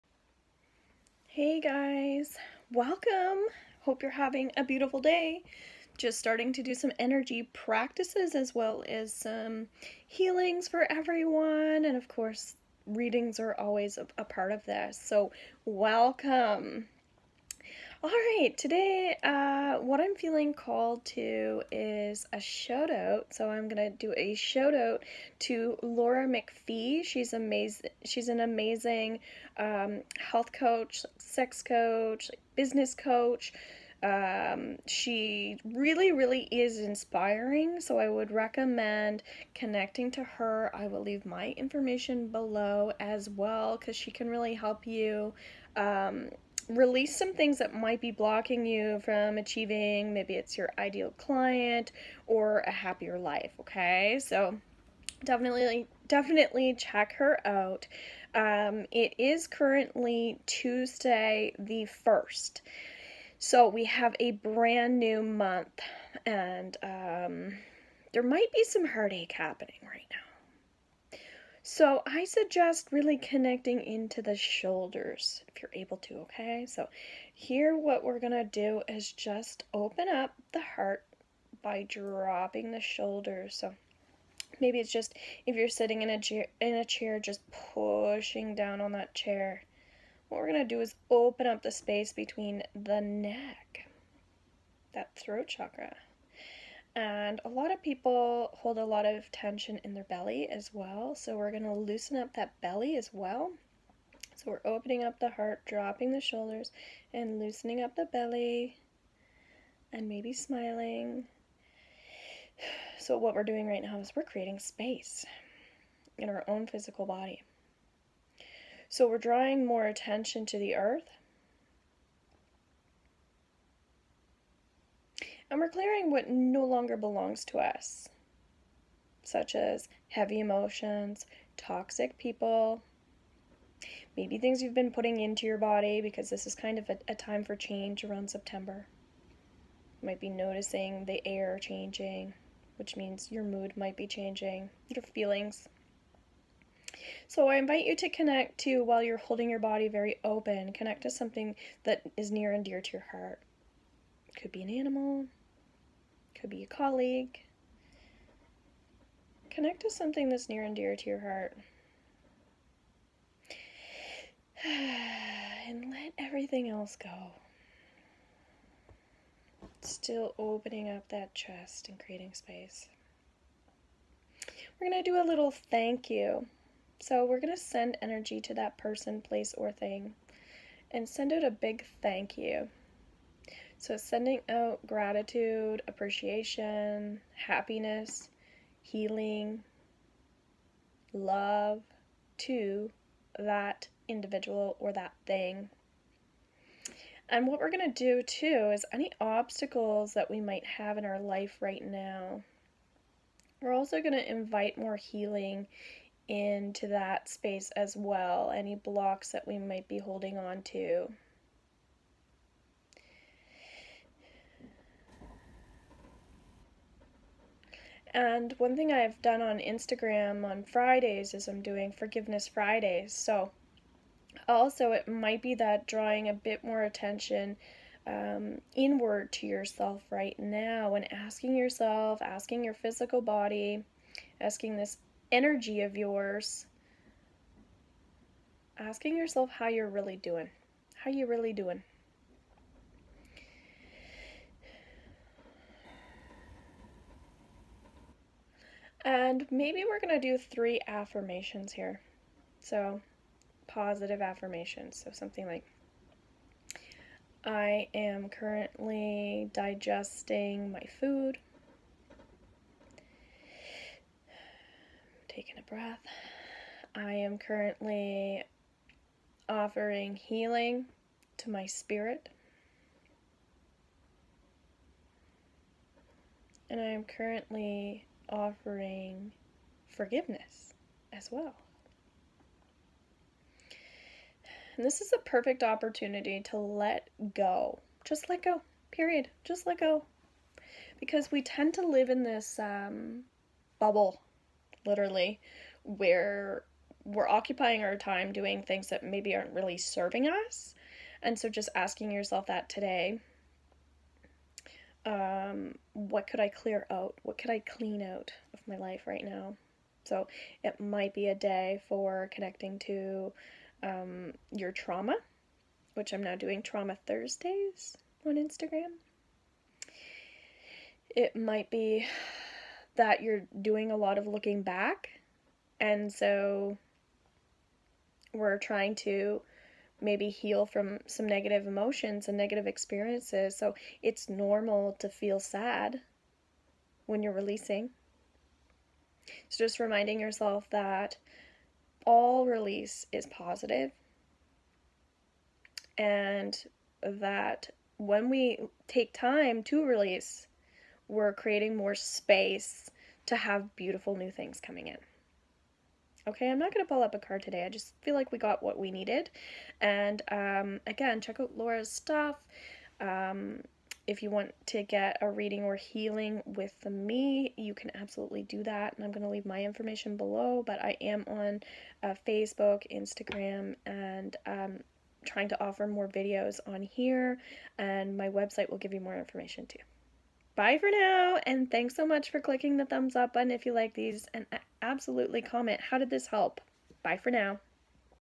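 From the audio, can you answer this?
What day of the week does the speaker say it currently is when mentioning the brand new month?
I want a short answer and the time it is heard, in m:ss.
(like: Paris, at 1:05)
Tuesday, at 1:00.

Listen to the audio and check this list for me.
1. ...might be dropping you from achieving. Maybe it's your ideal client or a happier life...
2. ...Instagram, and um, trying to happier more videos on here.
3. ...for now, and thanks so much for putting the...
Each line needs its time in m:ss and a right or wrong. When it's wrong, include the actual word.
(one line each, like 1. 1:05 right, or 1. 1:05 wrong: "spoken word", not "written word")
1. 0:47 wrong: "blocking", not "dropping"
2. 6:12 wrong: "offer", not "happier"
3. 6:20 wrong: "clicking", not "putting".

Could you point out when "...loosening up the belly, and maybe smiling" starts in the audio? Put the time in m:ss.
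1:47.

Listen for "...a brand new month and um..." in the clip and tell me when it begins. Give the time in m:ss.
1:04.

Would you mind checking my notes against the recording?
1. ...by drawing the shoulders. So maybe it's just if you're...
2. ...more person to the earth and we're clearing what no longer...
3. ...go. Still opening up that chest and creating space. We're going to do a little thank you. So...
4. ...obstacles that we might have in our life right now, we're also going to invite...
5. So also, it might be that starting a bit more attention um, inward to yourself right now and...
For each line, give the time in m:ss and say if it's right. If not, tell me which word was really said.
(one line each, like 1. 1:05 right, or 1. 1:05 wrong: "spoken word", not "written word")
1. 1:21 wrong: "dropping", not "drawing"
2. 1:59 wrong: "attention", not "person"
3. 2:47 right
4. 3:19 right
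5. 3:43 wrong: "drawing", not "starting".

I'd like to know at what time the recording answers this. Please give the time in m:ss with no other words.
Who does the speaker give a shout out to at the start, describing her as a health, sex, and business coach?
0:25.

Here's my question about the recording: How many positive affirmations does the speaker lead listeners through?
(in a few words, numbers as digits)
3.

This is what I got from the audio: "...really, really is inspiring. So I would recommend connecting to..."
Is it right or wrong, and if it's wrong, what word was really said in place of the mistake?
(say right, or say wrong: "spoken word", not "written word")
right.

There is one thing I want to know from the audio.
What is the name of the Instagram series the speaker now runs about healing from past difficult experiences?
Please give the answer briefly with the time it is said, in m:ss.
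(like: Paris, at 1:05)
Trauma Thursdays, at 5:16.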